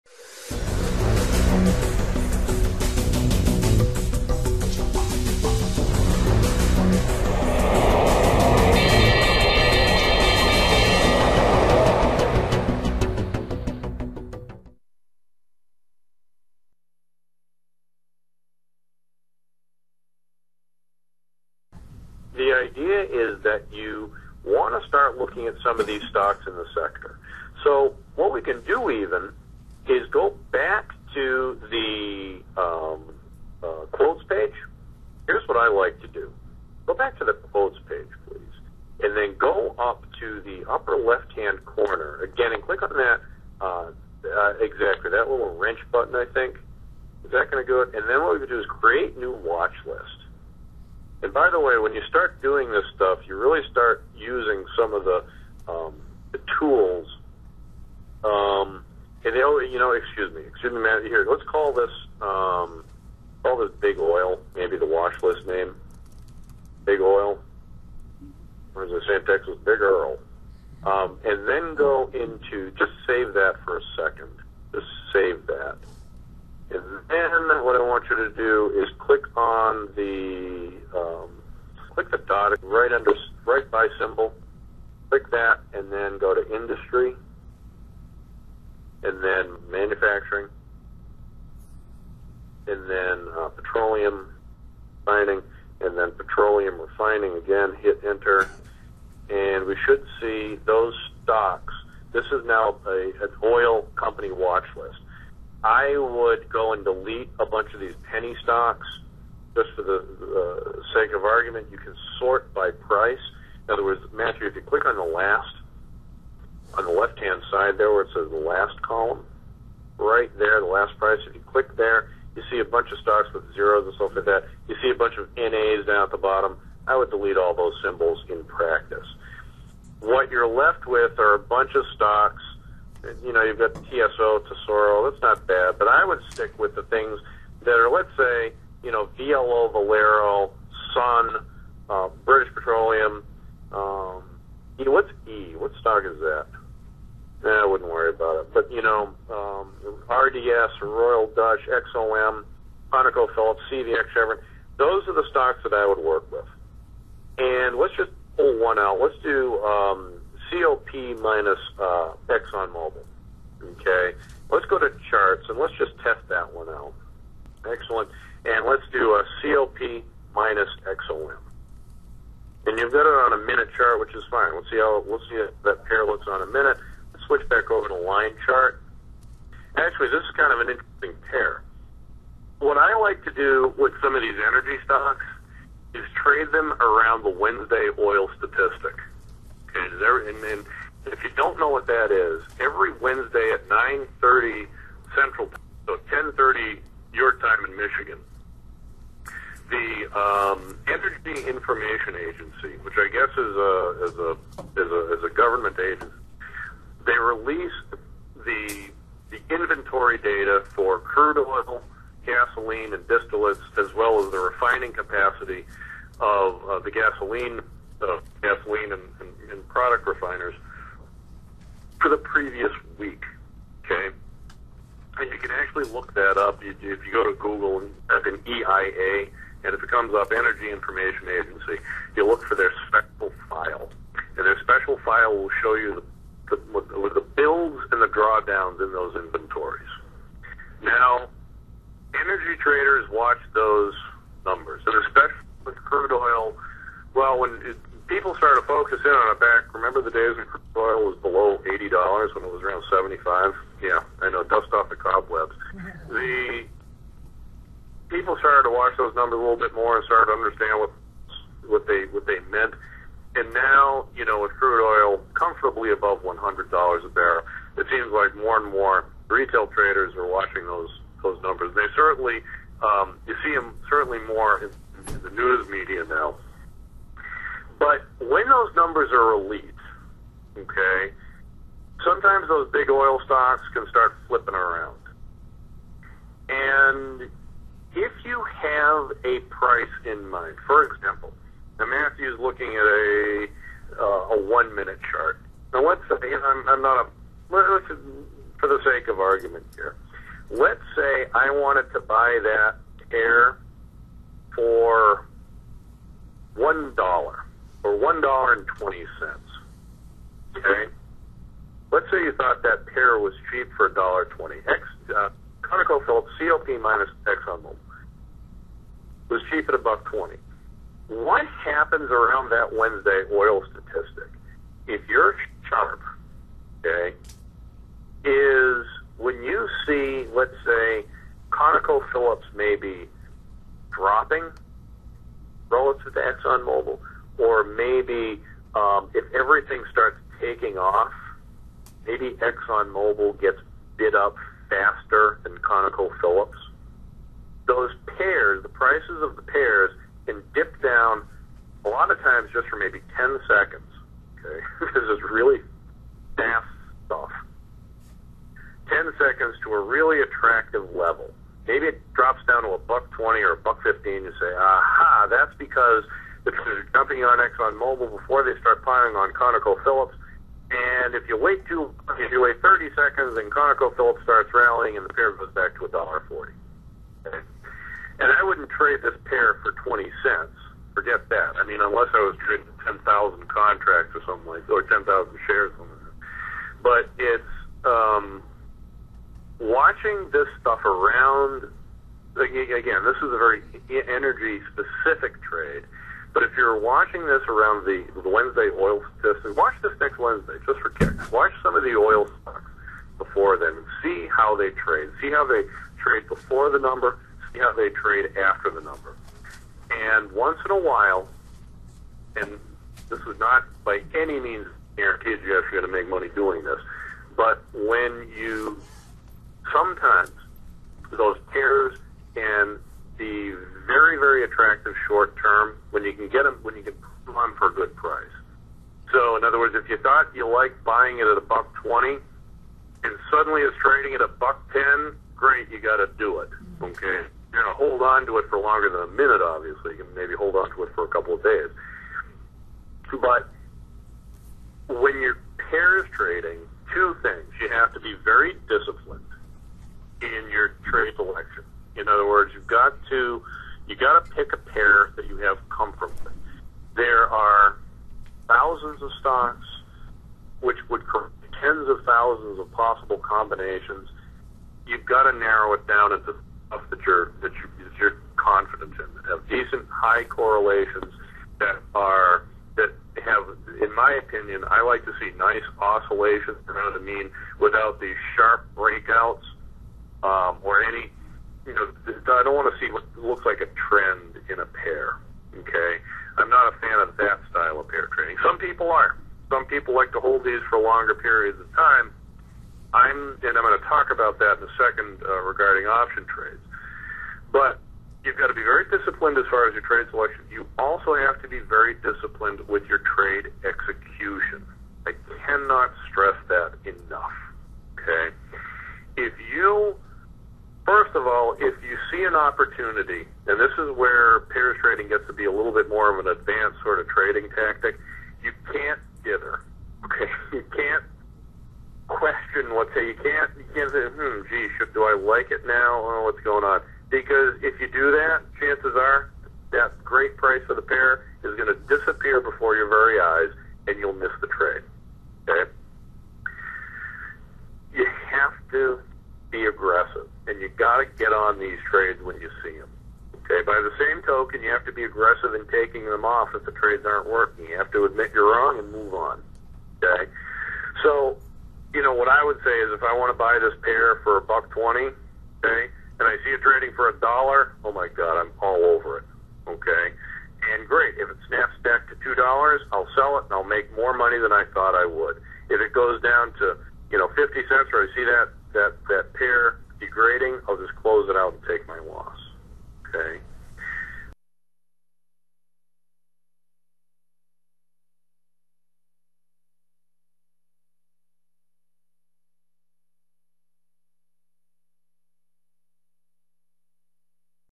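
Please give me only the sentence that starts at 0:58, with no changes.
Um, and they, oh, you know, excuse me, excuse me, Matt.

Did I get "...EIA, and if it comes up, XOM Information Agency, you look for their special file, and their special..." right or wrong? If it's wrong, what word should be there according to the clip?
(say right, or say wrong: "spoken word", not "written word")
wrong: "Energy", not "XOM".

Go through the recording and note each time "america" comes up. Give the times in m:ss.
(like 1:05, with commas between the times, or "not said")
not said.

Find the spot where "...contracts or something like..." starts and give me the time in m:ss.
6:23.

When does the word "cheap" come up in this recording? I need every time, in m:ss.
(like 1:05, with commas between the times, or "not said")
5:13, 5:19.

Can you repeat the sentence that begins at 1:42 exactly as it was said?
This is now a, an oil company watch list.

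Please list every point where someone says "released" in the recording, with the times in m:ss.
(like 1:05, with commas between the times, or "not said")
3:27, 4:39.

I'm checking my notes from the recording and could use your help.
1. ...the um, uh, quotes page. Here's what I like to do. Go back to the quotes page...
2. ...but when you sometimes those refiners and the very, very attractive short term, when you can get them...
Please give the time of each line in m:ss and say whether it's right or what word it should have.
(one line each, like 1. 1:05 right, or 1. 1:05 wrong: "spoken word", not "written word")
1. 0:31 right
2. 6:57 wrong: "pairs", not "refiners".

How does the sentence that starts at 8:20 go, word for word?
You also have to be very disciplined with your trade execution.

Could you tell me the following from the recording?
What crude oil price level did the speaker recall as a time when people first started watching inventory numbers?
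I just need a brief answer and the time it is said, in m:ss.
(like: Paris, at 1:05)
Around $75, at 4:12.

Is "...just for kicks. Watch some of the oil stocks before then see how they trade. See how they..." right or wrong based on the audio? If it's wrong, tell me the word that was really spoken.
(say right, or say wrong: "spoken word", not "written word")
right.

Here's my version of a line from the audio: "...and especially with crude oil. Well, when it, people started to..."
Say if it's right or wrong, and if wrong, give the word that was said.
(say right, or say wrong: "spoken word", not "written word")
right.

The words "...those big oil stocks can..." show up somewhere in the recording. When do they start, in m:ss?
4:42.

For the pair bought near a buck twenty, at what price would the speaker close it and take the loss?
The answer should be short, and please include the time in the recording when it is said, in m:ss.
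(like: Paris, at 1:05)
50 cents, at 9:27.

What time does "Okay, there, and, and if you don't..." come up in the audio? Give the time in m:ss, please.
3:09.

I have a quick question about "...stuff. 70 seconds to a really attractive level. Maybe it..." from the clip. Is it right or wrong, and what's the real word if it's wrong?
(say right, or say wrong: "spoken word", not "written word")
wrong: "10", not "70".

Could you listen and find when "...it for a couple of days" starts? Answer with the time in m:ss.
7:20.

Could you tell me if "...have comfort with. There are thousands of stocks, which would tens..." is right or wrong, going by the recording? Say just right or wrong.
right.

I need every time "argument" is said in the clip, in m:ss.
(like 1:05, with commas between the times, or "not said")
1:51, 4:59.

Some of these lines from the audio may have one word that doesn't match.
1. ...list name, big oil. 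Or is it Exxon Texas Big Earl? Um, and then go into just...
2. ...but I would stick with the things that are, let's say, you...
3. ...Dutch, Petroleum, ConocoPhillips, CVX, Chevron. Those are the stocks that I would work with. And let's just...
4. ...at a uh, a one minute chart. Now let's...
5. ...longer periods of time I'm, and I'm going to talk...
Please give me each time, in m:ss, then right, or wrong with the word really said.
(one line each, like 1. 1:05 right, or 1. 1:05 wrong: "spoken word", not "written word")
1. 1:05 wrong: "San", not "Exxon"
2. 2:15 right
3. 2:31 wrong: "XOM", not "Petroleum"
4. 4:52 right
5. 8:10 right.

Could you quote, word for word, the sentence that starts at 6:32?
Again, this is a very energy specific trade.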